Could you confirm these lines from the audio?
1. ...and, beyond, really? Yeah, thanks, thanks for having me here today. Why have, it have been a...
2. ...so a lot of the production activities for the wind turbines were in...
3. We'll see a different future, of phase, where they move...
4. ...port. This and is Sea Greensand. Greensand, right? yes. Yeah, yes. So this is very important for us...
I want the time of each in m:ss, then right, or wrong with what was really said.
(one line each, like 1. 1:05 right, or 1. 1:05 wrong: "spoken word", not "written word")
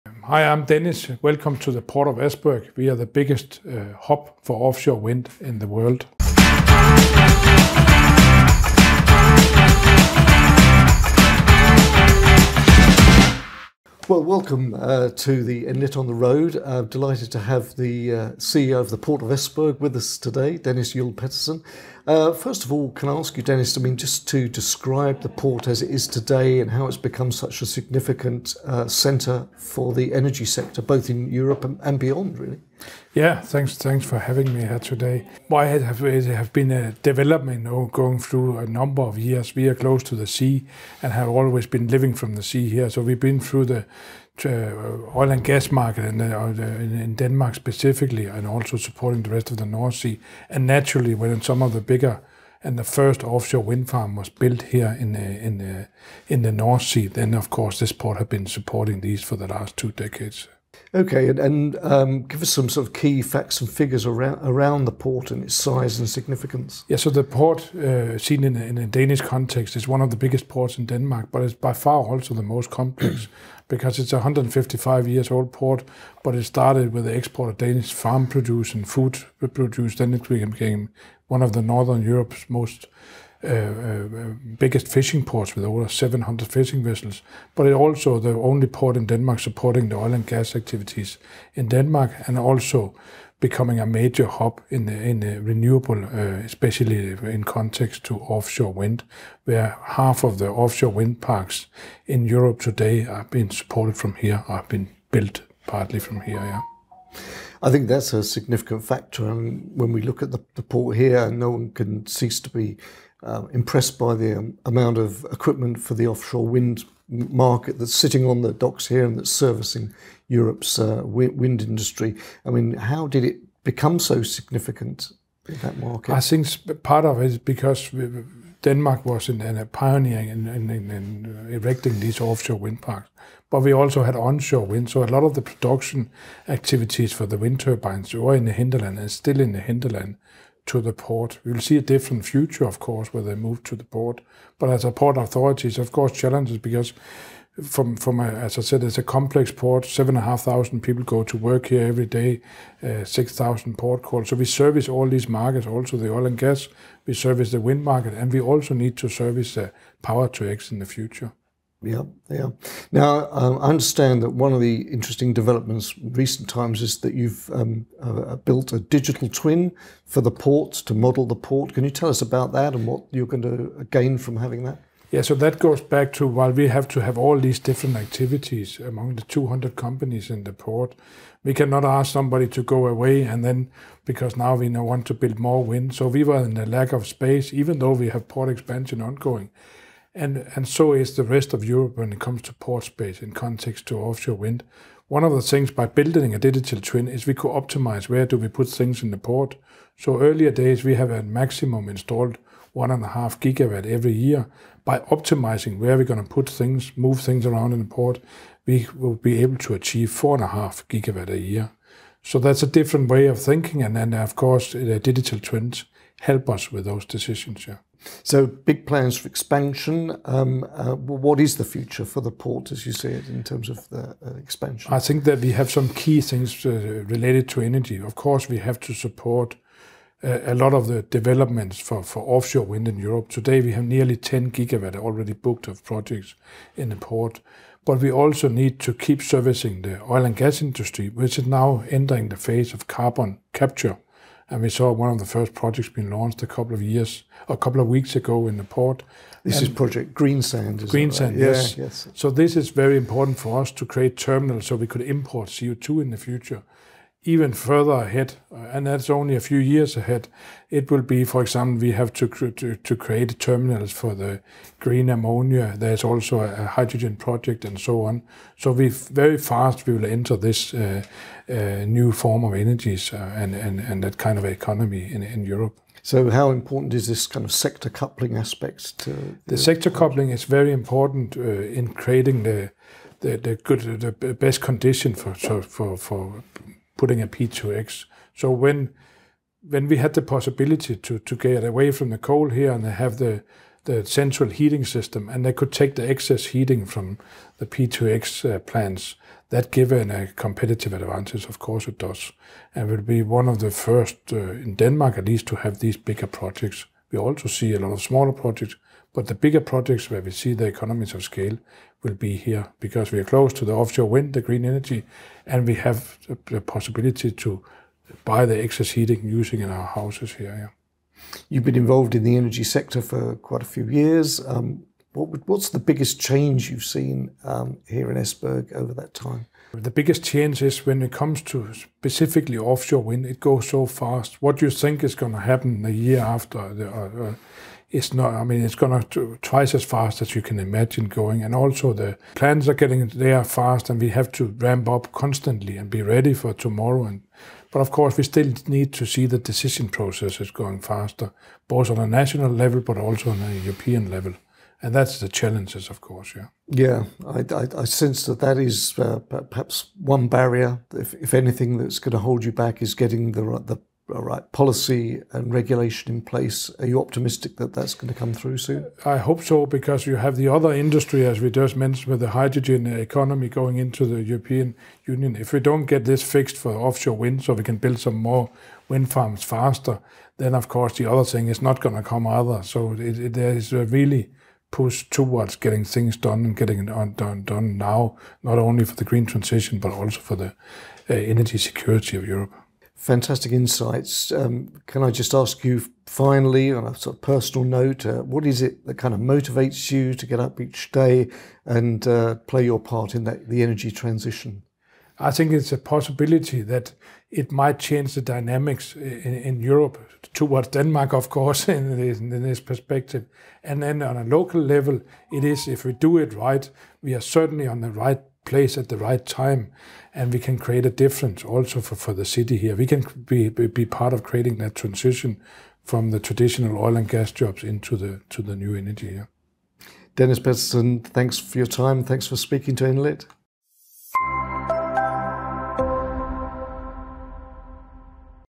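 1. 0:31 right
2. 2:14 right
3. 2:21 wrong: "course", not "phase"
4. 4:08 wrong: "Project", not "Sea".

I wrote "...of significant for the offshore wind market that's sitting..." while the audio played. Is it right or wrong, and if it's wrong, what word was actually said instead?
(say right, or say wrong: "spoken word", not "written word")
wrong: "equipment", not "significant".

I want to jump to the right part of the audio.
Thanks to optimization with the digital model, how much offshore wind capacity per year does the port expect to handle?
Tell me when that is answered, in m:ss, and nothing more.
3:30.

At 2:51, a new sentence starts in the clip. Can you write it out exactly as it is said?
Can you tell us about that and what you're going to gain from having that?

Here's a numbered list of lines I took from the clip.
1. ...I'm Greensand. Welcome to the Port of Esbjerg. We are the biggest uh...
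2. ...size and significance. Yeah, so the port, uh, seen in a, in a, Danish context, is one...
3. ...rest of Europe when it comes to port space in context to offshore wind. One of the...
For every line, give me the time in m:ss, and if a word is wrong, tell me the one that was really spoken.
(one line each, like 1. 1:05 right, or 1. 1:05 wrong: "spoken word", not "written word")
1. 0:00 wrong: "Dennis", not "Greensand"
2. 1:05 right
3. 3:11 right.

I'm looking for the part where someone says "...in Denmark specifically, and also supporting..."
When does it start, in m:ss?
0:47.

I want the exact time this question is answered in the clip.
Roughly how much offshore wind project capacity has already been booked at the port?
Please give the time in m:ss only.
3:53.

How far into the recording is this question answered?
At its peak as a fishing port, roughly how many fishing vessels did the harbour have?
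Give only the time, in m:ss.
1:25.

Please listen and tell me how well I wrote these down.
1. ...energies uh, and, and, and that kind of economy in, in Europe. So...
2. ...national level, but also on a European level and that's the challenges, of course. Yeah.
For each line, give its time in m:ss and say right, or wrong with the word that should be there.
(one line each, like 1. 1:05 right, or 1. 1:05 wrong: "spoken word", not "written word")
1. 4:32 right
2. 5:52 right.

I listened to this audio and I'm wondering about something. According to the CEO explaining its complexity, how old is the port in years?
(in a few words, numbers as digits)
155.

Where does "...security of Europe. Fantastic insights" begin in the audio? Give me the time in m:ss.
6:31.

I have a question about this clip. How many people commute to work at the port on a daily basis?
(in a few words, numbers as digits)
7,500.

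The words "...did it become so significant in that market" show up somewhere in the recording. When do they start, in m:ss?
2:03.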